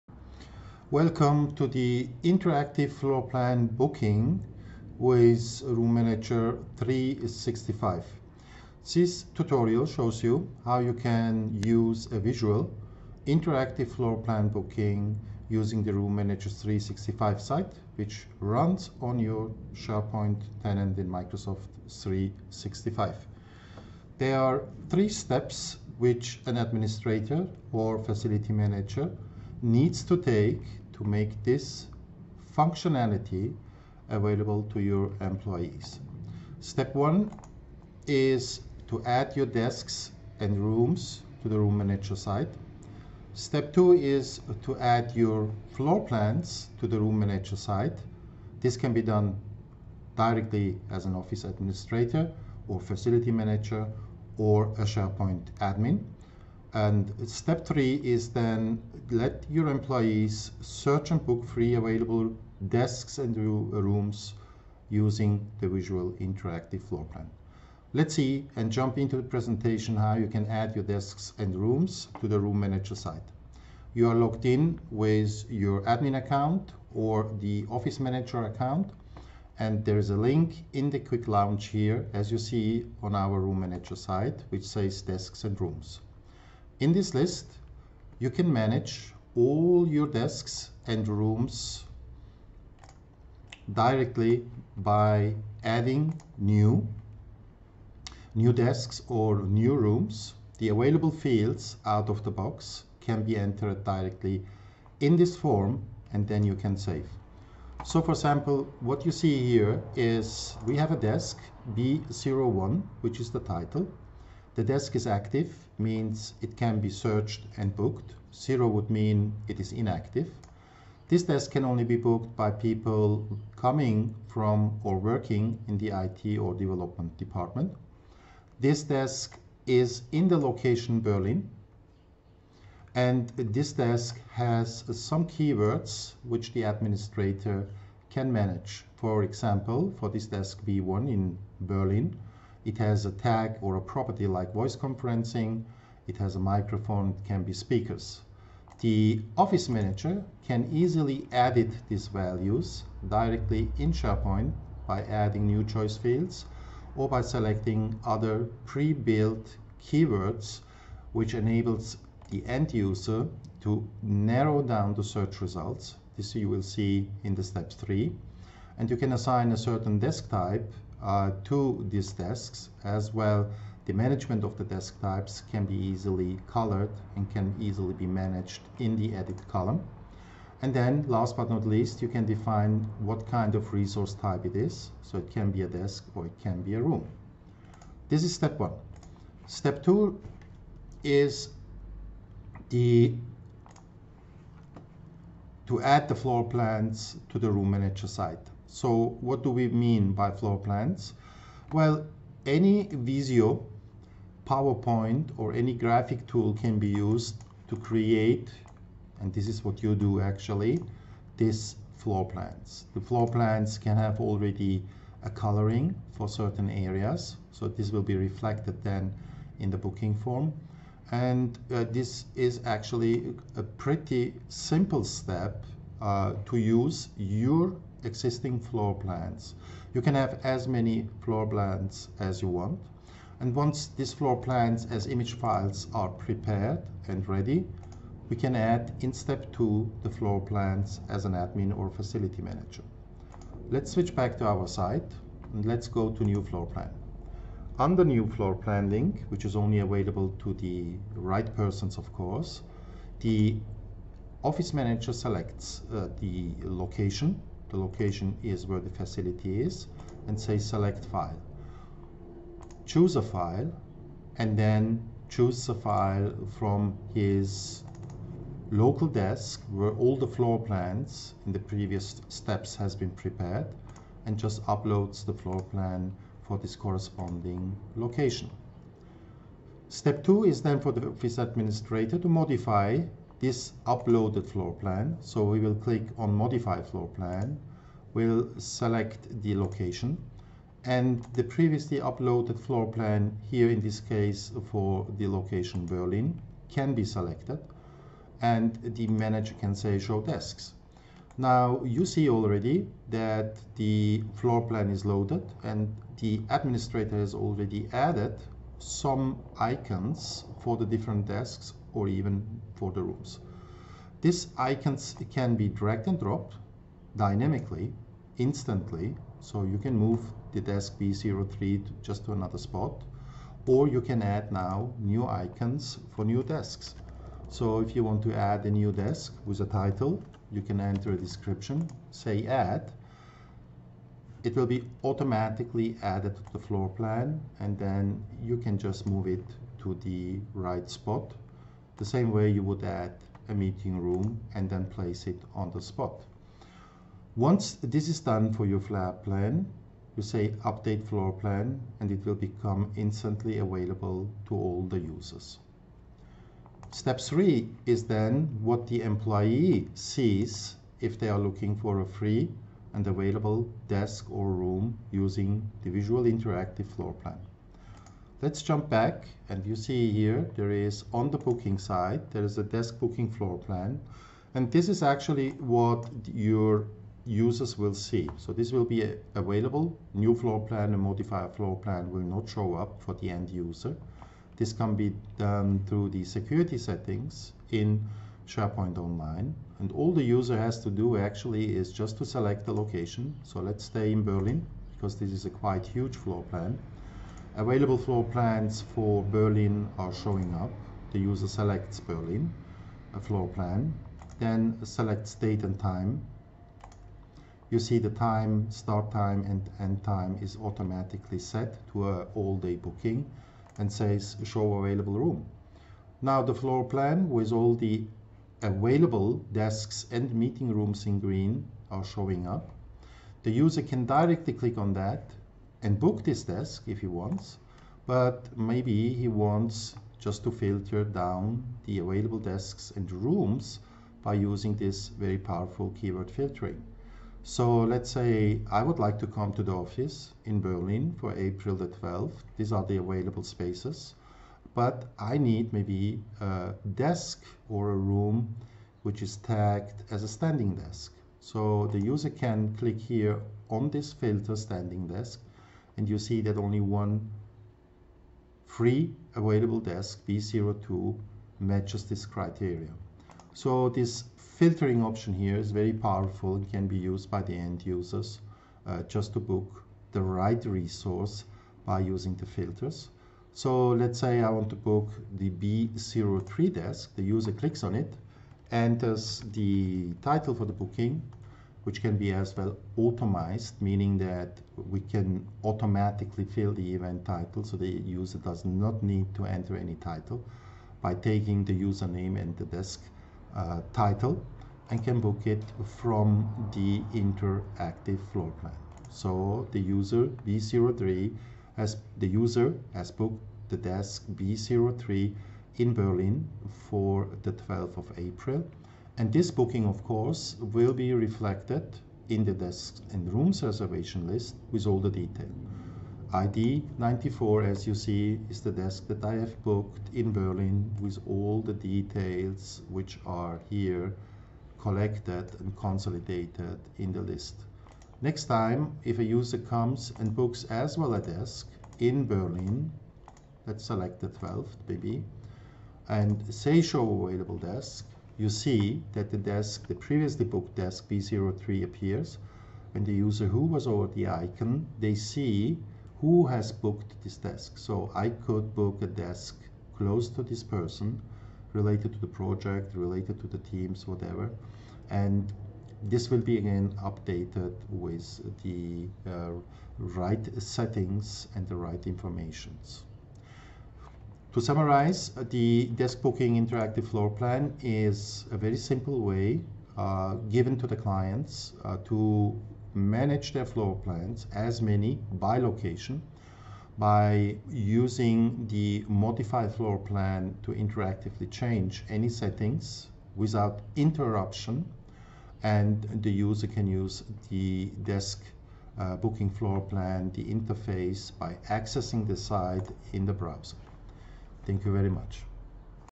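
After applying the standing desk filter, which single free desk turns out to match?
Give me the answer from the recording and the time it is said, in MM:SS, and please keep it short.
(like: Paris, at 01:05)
B02, at 07:40.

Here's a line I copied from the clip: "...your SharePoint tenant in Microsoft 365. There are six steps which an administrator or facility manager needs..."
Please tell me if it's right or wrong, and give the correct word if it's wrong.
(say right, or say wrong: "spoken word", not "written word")
wrong: "three", not "six".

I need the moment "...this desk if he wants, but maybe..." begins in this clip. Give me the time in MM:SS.
07:06.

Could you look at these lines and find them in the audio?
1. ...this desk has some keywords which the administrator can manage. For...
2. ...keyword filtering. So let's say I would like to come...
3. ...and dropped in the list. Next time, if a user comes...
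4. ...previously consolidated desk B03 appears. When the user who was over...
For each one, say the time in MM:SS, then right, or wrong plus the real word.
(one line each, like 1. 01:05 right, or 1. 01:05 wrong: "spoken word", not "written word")
1. 02:13 right
2. 07:15 right
3. 08:45 wrong: "consolidated", not "dropped"
4. 08:59 wrong: "booked", not "consolidated".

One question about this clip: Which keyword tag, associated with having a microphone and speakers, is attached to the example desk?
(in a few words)
voice conferencing.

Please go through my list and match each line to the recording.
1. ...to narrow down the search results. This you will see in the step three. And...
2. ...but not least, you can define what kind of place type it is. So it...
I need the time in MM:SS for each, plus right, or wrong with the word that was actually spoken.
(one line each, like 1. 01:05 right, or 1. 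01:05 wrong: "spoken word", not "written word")
1. 02:43 right
2. 03:01 wrong: "resource", not "place".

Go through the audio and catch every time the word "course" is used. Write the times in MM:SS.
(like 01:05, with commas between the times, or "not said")
04:12, 08:30.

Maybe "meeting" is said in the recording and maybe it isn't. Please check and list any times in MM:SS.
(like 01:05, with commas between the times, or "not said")
05:43, 07:00.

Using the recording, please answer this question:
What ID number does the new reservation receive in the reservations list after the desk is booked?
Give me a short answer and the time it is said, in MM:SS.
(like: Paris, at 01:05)
94, at 08:36.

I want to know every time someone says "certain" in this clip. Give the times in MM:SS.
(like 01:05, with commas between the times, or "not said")
02:49, 03:36.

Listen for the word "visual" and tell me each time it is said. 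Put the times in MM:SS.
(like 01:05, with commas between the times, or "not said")
00:12, 01:05, 06:05.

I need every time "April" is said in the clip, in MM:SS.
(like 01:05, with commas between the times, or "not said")
07:21, 08:28.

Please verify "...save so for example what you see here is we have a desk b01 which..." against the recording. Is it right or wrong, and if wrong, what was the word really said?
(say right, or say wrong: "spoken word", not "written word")
right.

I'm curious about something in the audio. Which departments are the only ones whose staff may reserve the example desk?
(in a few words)
IT or development.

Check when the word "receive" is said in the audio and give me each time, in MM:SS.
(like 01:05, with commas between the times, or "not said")
not said.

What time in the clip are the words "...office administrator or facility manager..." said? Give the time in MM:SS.
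00:51.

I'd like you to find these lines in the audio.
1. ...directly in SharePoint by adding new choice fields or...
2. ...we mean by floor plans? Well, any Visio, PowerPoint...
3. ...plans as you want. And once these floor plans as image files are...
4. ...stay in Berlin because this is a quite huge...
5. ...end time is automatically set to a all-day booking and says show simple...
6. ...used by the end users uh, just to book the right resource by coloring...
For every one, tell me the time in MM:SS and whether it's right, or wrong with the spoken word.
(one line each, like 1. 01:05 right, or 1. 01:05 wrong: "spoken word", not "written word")
1. 02:33 right
2. 03:19 right
3. 03:51 right
4. 06:33 right
5. 06:49 wrong: "available", not "simple"
6. 07:46 wrong: "using", not "coloring".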